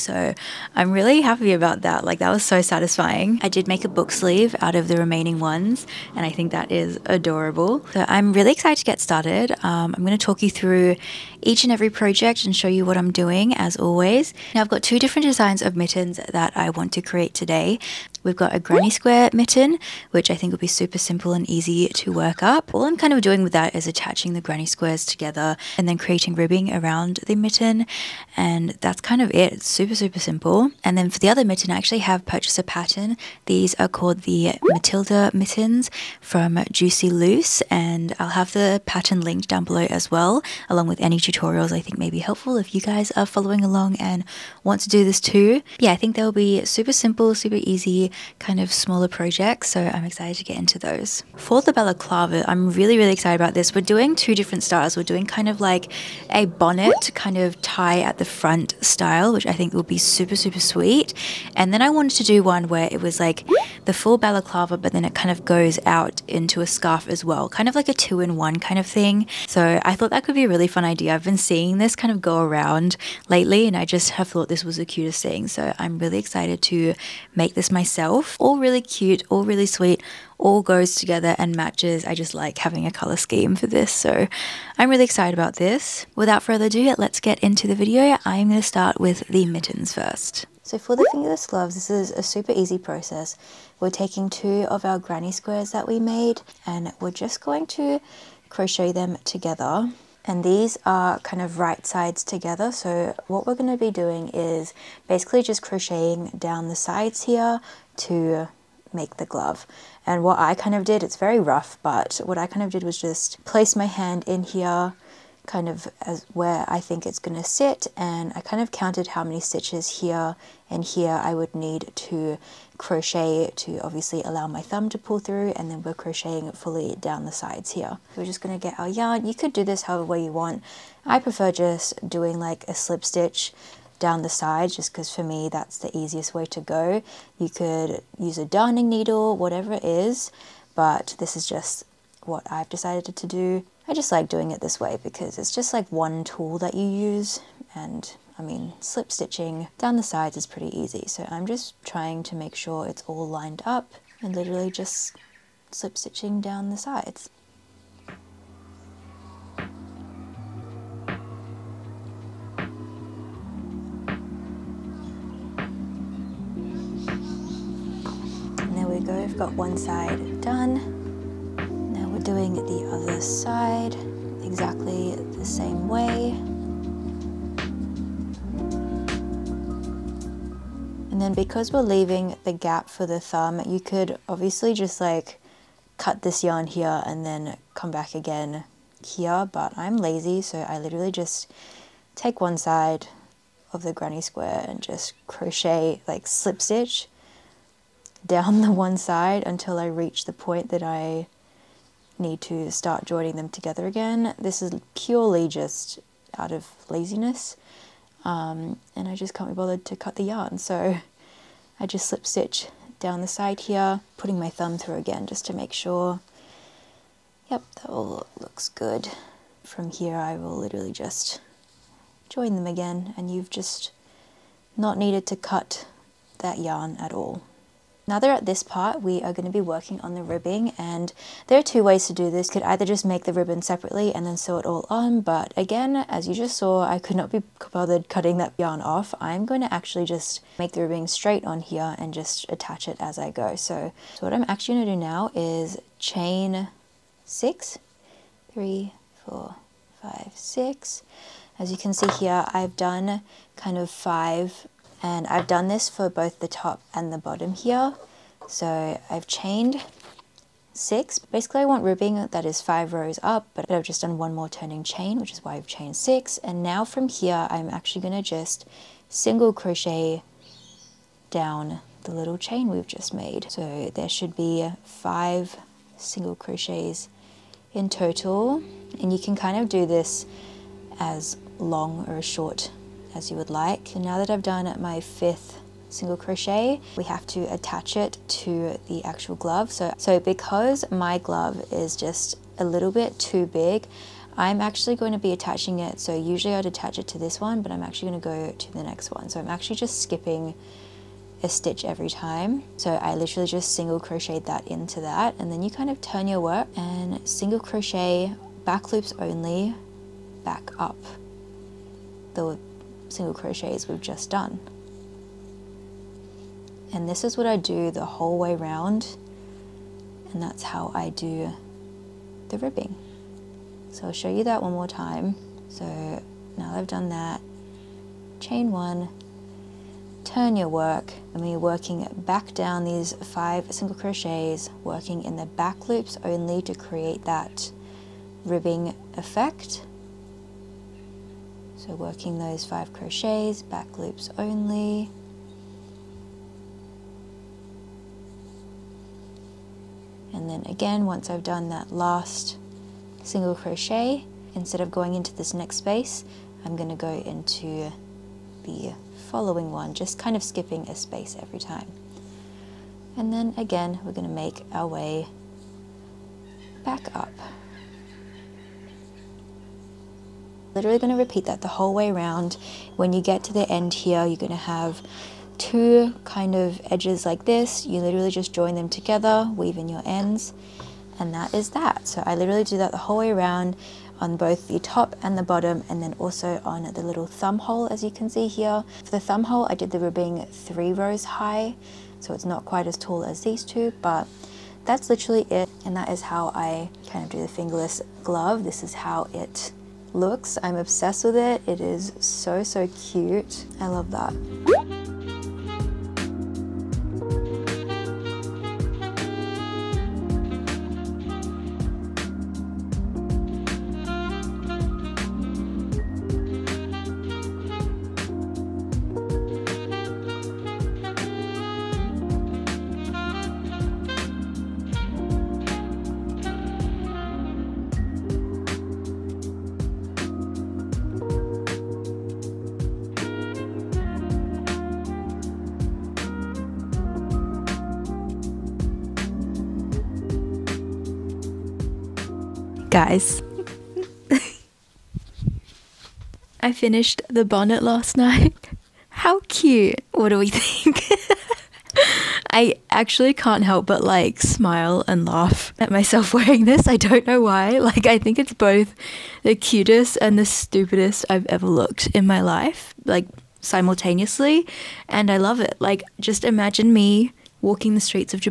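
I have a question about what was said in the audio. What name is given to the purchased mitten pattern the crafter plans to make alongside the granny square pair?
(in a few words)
Matilda mittens.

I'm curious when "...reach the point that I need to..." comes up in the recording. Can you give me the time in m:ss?
3:19.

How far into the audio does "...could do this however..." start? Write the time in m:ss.
2:09.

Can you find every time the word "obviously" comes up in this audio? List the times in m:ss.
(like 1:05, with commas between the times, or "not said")
2:03, 3:04.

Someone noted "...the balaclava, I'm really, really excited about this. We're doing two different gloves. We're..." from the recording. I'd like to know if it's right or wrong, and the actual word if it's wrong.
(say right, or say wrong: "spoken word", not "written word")
wrong: "styles", not "gloves".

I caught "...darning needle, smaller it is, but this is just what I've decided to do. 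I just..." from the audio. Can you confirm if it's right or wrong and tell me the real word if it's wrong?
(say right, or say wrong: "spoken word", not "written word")
wrong: "whatever", not "smaller".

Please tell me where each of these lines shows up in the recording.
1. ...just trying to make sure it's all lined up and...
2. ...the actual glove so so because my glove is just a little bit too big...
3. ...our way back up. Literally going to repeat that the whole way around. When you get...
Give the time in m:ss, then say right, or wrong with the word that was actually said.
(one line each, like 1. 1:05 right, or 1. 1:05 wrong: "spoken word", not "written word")
1. 2:31 right
2. 4:48 right
3. 6:04 right.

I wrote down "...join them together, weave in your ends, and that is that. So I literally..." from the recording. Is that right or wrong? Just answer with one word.
right.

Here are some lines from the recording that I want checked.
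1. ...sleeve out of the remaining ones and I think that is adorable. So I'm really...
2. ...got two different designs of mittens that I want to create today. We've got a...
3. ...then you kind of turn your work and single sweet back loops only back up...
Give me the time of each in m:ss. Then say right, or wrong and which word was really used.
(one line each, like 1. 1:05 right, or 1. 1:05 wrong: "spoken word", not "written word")
1. 0:04 right
2. 0:14 right
3. 5:05 wrong: "crochet", not "sweet".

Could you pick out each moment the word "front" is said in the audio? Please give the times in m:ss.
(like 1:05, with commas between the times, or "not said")
0:58.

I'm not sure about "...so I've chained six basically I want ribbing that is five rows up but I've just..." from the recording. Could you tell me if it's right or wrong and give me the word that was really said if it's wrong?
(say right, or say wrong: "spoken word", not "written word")
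right.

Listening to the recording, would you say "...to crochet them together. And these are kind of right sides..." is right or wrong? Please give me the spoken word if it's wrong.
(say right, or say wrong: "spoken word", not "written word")
right.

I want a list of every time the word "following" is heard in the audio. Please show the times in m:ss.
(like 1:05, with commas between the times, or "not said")
0:43, 5:59.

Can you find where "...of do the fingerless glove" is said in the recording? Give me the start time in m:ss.
6:37.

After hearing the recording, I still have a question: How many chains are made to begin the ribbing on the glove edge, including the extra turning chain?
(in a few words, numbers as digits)
6.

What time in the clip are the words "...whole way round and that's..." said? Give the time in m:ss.
5:18.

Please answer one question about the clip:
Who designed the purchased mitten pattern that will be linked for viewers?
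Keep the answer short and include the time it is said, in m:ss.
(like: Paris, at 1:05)
Juicy Loose, at 0:36.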